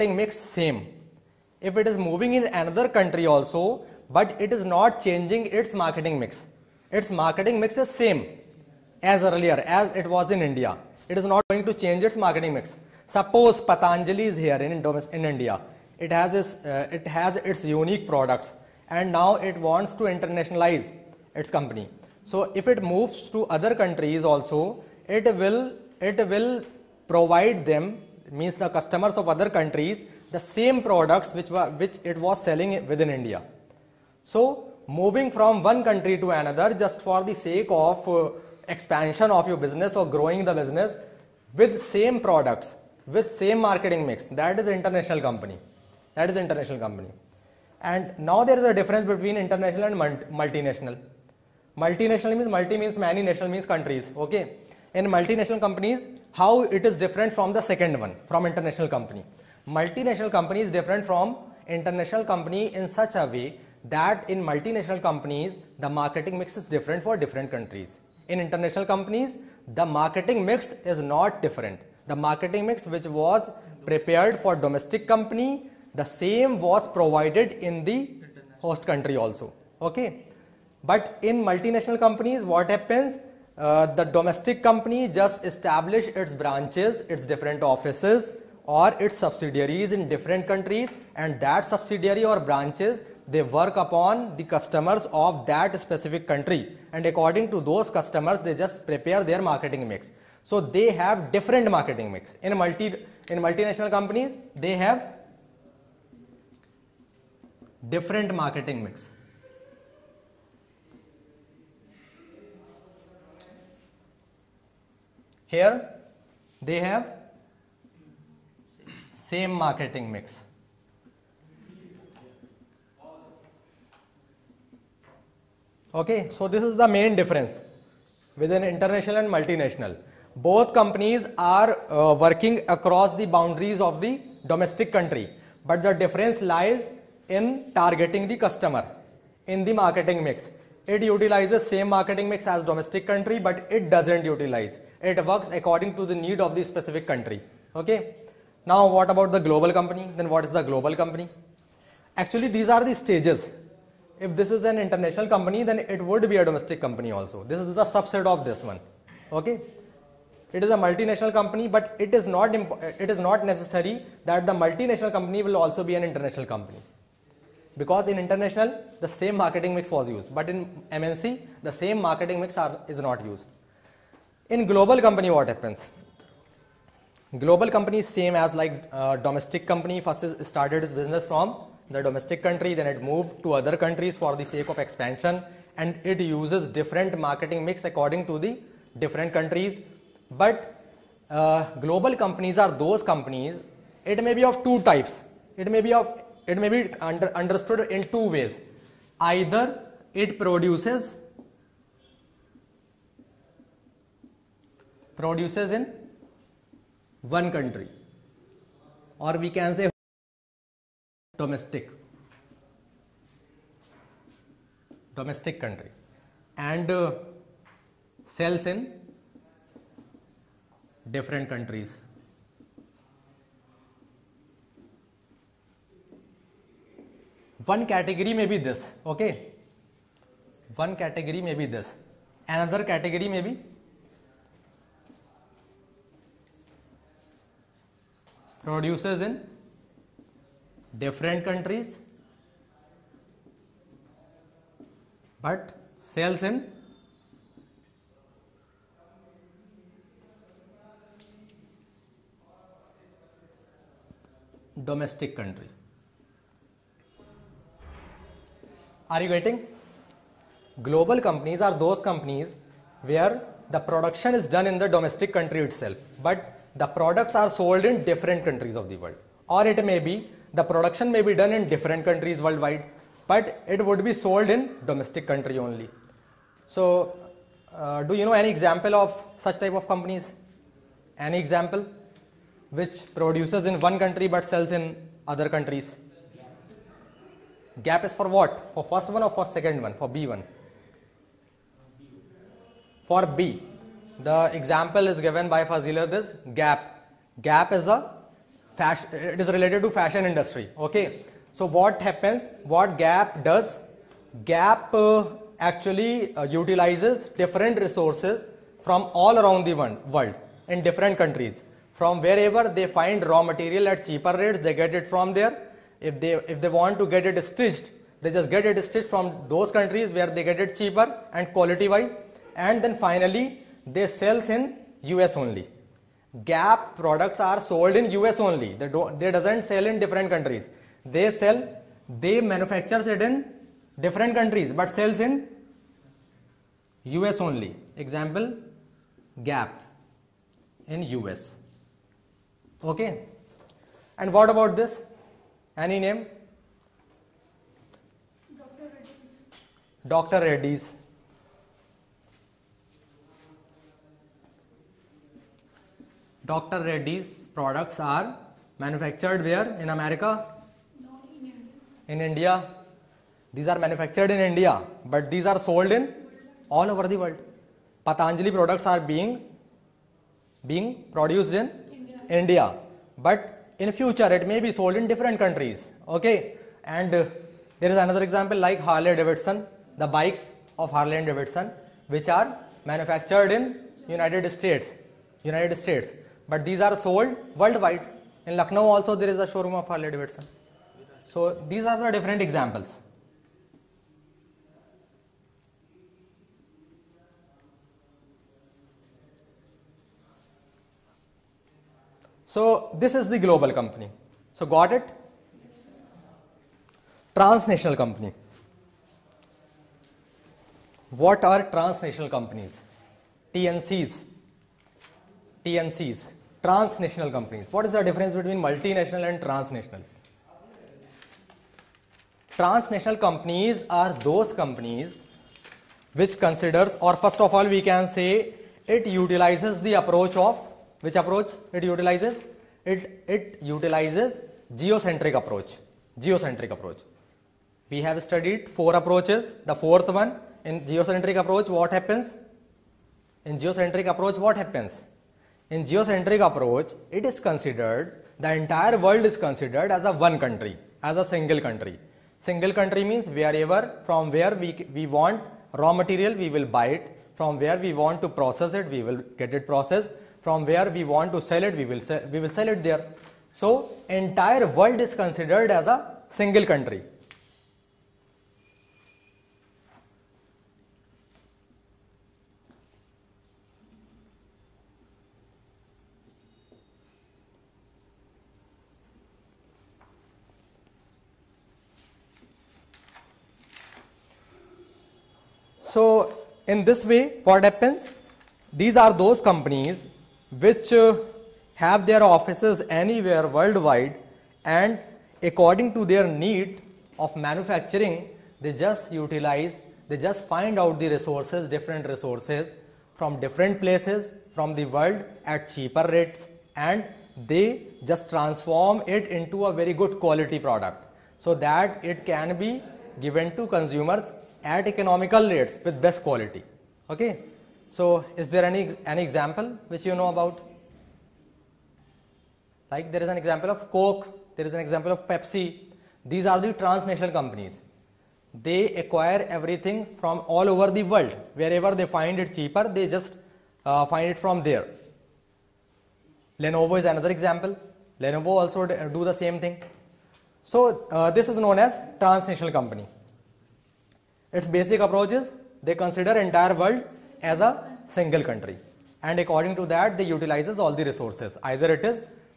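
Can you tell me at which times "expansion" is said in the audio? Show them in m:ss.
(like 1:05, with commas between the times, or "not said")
0:38, 3:04.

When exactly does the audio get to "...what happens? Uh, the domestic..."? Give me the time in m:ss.
1:22.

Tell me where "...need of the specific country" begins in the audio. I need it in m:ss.
2:26.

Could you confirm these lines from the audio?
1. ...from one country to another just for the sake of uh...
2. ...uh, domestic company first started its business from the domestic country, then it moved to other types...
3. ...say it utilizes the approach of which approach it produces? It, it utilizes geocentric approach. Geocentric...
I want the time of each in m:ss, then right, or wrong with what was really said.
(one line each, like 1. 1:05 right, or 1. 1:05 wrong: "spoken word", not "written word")
1. 0:35 right
2. 2:58 wrong: "countries", not "types"
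3. 7:08 wrong: "utilizes", not "produces".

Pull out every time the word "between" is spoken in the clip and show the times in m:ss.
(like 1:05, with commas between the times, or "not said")
0:49, 6:58.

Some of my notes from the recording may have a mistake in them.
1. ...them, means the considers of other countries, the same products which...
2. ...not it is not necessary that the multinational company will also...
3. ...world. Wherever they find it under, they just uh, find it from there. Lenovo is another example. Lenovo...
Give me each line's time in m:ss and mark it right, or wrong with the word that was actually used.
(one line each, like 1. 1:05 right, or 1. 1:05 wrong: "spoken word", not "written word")
1. 0:27 wrong: "customers", not "considers"
2. 2:42 right
3. 8:51 wrong: "cheaper", not "under".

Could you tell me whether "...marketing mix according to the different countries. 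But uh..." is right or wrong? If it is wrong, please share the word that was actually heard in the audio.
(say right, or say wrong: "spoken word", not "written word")
right.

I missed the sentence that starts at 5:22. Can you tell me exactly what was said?
And then finally, they sell in US only.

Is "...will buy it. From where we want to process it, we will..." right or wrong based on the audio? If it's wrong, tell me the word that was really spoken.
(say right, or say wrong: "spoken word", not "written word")
right.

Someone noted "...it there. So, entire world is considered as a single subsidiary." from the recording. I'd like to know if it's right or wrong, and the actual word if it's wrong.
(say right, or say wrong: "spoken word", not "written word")
wrong: "country", not "subsidiary".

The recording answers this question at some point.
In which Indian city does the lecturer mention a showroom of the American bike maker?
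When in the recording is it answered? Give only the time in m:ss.
6:28.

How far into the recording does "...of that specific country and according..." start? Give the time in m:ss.
1:35.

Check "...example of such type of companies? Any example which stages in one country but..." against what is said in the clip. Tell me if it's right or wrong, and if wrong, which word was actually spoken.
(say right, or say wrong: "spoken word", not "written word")
wrong: "produces", not "stages".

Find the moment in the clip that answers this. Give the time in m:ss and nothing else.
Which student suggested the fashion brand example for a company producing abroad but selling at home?
4:55.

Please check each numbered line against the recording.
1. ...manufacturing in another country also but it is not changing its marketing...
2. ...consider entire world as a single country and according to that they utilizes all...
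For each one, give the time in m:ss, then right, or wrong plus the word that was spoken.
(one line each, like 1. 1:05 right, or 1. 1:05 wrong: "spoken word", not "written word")
1. 0:01 wrong: "moving", not "manufacturing"
2. 9:05 right.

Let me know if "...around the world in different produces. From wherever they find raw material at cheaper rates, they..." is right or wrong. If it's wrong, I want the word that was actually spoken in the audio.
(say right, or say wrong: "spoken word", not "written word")
wrong: "countries", not "produces".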